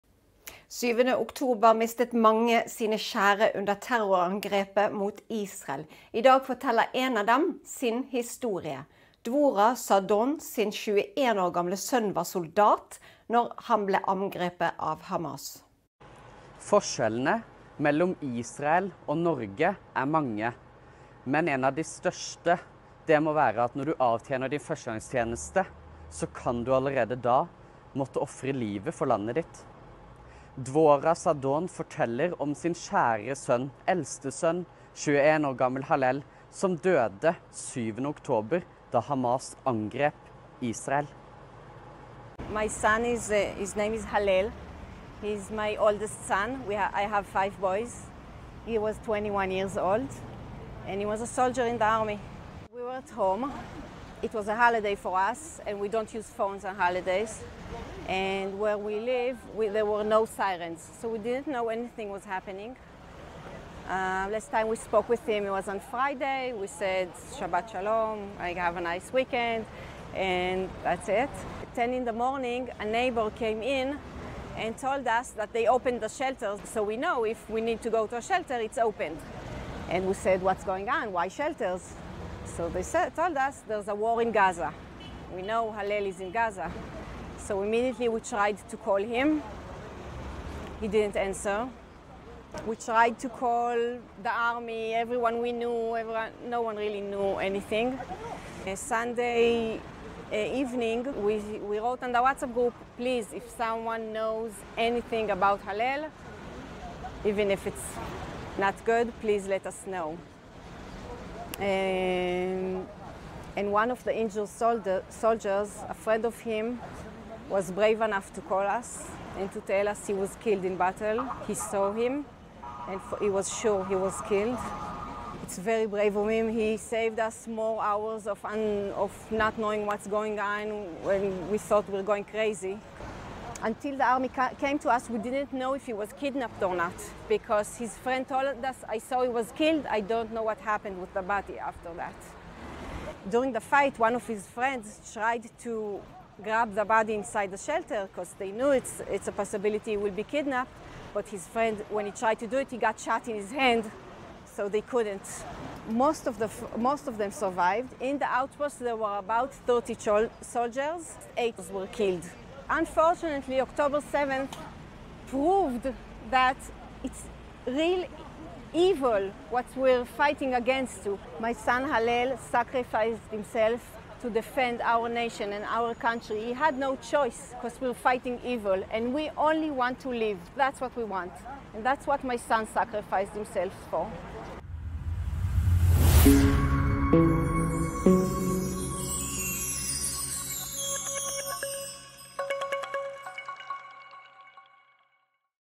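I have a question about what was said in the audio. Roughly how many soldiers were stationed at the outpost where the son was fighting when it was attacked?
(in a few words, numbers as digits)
30.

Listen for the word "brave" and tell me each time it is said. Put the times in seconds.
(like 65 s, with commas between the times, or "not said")
117 s, 125 s.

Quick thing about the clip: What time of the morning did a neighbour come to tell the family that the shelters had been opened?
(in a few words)
10.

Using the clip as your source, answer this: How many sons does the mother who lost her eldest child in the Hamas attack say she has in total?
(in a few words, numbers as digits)
5.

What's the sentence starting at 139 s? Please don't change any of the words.
I don't know what happened with the body after that.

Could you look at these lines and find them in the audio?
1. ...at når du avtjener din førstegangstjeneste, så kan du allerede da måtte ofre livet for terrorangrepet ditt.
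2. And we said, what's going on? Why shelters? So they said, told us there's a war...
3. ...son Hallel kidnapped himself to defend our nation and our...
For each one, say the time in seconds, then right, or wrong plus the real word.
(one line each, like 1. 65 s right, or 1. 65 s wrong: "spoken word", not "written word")
1. 23 s wrong: "landet", not "terrorangrepet"
2. 79 s right
3. 171 s wrong: "sacrificed", not "kidnapped".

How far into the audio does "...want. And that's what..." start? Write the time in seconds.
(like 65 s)
181 s.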